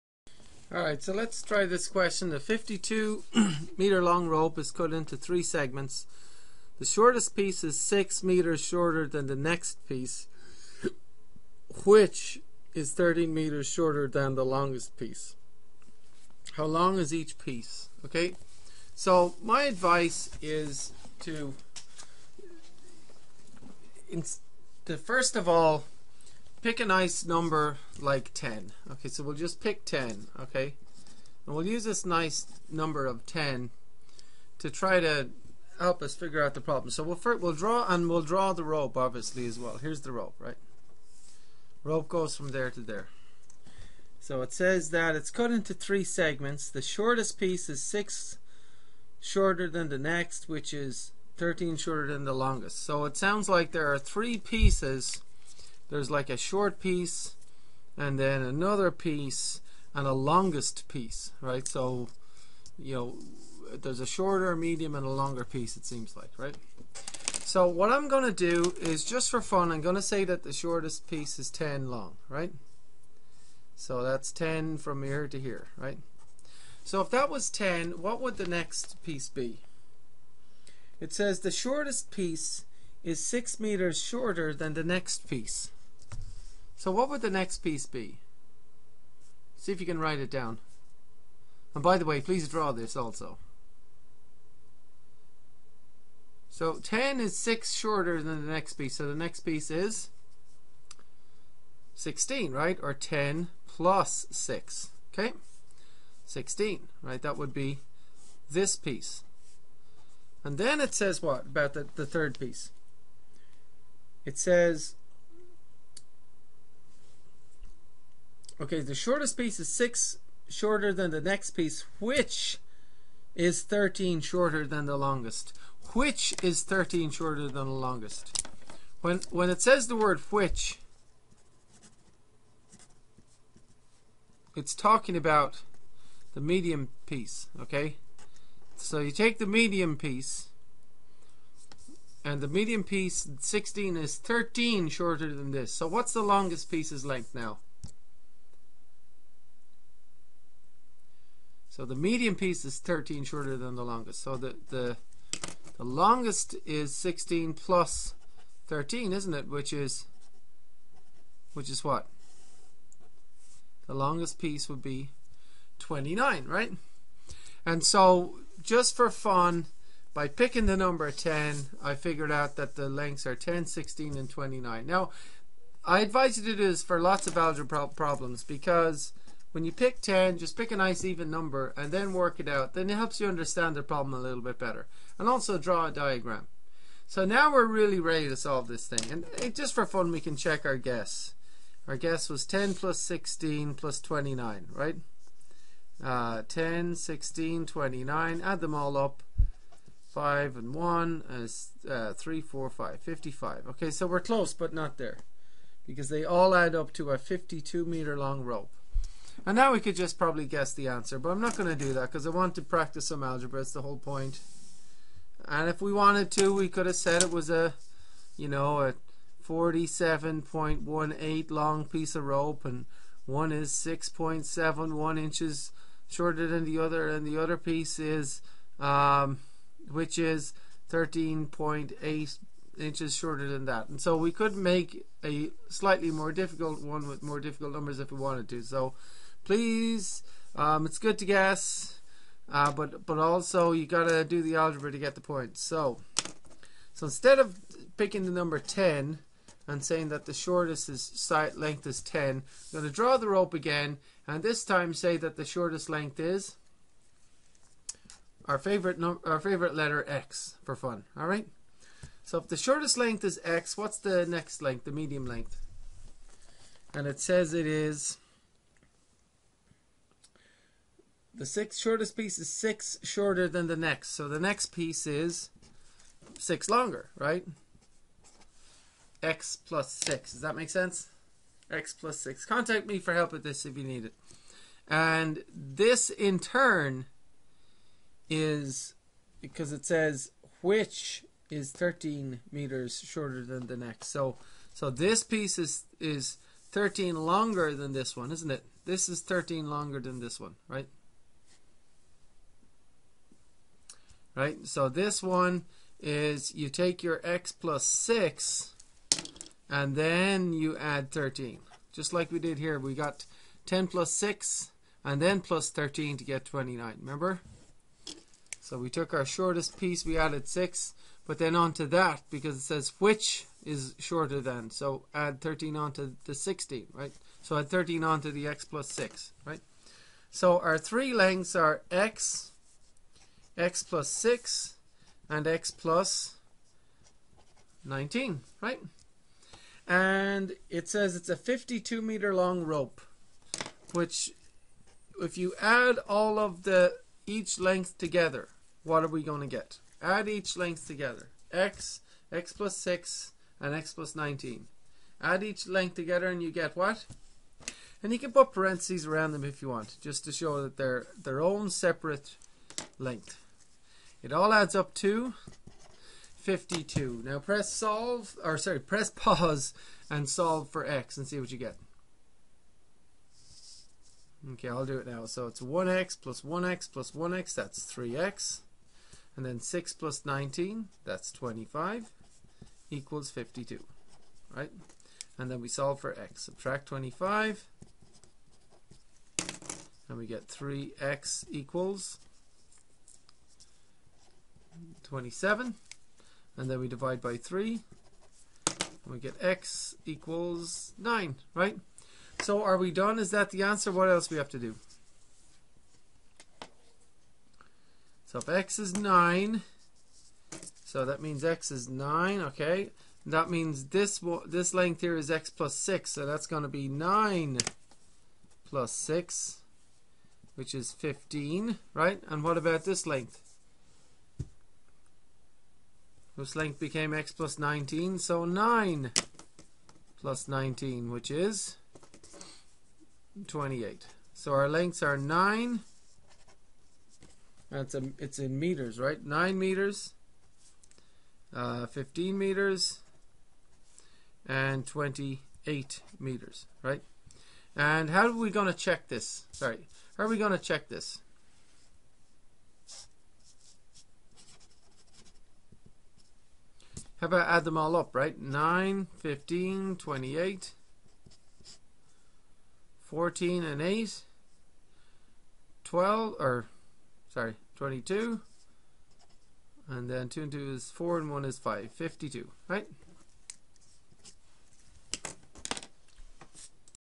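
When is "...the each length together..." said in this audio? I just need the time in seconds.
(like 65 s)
346 s.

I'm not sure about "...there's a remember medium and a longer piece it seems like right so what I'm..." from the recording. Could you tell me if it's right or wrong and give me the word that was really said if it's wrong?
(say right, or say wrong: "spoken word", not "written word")
wrong: "shorter", not "remember".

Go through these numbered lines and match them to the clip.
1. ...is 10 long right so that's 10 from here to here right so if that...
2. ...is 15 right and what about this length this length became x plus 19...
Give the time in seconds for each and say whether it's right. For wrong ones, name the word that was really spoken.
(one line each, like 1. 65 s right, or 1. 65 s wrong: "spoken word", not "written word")
1. 71 s right
2. 420 s right.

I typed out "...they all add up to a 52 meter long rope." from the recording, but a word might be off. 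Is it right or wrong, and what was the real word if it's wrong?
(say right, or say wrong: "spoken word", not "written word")
right.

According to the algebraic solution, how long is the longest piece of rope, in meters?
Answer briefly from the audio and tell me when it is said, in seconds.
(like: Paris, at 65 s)
28 meters, at 444 s.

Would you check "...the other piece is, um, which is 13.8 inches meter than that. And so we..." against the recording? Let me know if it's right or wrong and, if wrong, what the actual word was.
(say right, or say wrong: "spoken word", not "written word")
wrong: "shorter", not "meter".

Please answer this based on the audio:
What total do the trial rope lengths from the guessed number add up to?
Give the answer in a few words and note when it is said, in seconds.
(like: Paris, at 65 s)
55, at 202 s.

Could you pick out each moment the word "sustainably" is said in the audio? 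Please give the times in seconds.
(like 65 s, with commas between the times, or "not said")
not said.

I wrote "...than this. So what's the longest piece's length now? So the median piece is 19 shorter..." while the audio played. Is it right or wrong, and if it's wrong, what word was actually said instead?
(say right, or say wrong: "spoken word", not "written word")
wrong: "13", not "19".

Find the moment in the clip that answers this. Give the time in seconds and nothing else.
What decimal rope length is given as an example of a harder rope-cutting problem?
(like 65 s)
219 s.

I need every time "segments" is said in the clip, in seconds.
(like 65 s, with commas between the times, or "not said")
5 s, 46 s.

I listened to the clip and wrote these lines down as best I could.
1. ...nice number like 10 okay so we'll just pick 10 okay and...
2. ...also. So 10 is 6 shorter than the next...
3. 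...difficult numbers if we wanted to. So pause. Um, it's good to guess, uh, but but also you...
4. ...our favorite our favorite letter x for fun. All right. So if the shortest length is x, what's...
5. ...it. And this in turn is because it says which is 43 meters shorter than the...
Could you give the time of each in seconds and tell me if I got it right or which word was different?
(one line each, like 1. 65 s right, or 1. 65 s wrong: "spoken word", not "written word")
1. 26 s right
2. 92 s right
3. 237 s wrong: "please", not "pause"
4. 258 s right
5. 284 s wrong: "13", not "43".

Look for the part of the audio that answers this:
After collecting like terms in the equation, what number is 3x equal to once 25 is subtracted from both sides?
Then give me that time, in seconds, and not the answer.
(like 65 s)
395 s.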